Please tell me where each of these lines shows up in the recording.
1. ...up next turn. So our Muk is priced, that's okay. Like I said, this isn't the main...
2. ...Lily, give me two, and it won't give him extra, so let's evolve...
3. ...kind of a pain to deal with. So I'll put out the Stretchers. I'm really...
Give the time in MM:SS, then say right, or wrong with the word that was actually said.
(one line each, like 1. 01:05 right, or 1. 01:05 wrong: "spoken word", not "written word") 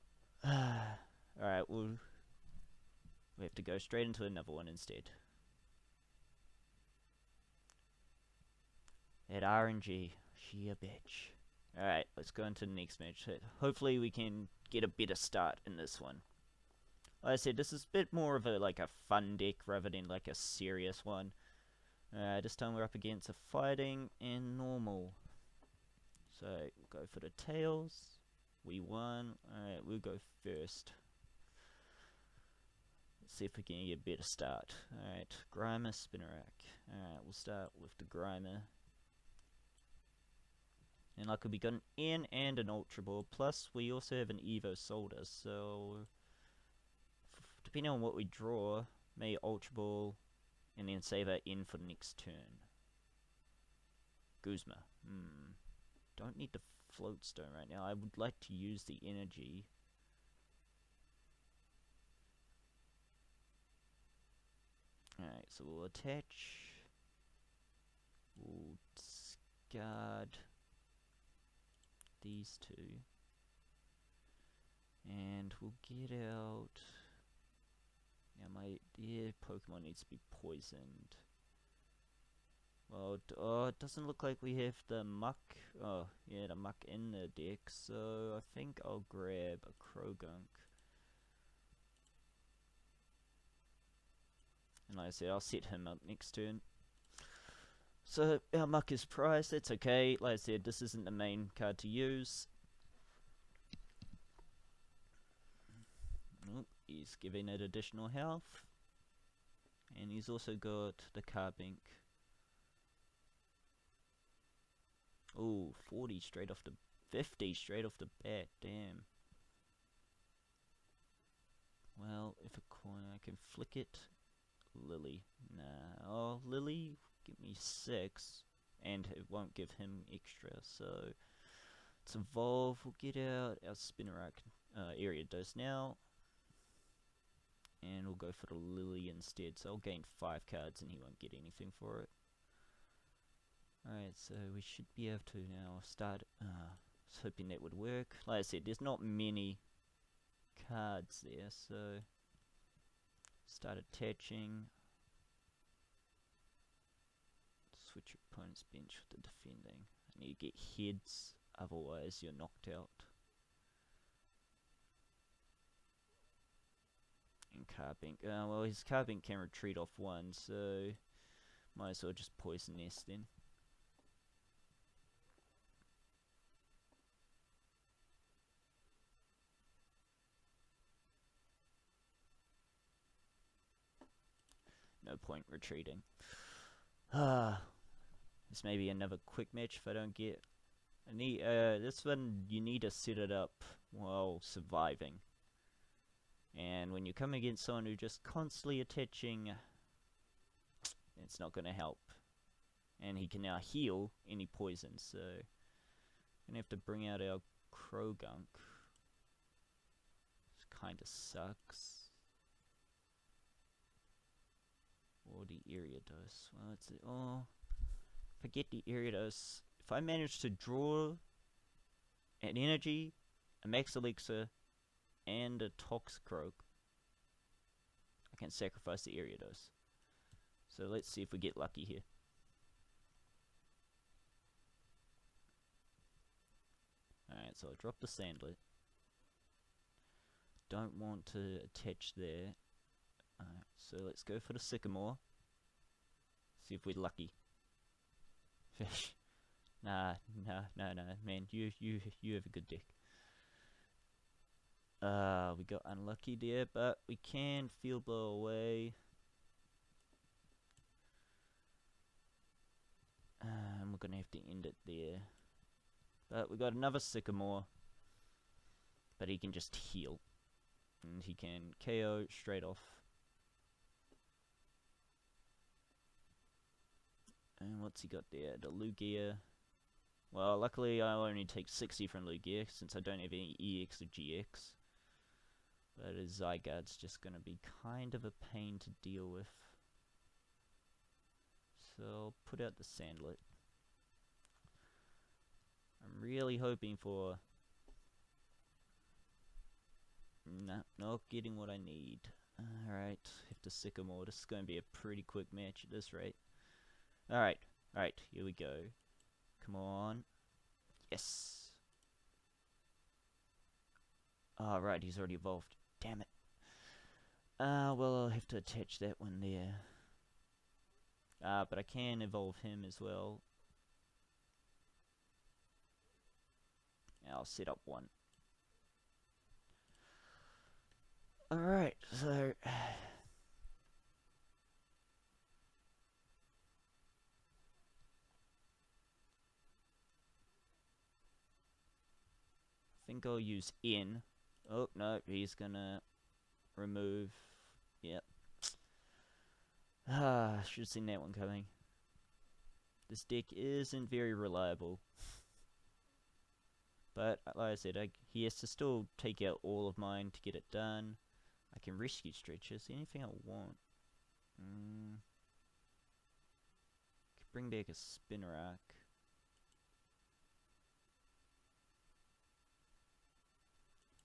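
1. 01:35 right
2. 02:06 wrong: "six", not "two"
3. 04:47 wrong: "Salandit", not "Stretchers".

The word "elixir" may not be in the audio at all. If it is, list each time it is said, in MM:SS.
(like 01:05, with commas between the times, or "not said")
03:43.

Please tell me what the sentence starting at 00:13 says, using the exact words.
Hopefully we can get a better start in this one.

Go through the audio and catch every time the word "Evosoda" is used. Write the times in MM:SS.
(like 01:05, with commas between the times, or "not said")
00:44.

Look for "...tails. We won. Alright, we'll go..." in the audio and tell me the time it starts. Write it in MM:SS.
00:27.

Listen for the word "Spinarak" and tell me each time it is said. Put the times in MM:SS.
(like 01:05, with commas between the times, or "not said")
00:35, 02:13, 06:07.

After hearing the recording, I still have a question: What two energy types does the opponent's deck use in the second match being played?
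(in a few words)
Fighting and normal.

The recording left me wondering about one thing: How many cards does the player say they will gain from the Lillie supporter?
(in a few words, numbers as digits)
5.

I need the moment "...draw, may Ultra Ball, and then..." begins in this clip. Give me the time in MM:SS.
00:48.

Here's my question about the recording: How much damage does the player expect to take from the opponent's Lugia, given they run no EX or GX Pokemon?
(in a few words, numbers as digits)
60.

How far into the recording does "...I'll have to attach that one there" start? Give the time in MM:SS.
05:18.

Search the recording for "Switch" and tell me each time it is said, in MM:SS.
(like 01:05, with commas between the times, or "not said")
02:37.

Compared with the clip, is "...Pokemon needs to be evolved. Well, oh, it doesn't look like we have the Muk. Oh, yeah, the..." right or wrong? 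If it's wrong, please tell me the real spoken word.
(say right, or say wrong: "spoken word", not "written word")
wrong: "poisoned", not "evolved".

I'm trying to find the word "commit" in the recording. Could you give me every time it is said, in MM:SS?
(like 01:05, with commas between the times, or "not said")
not said.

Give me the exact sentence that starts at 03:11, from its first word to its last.
I need, uh, this one, you need to set it up while surviving.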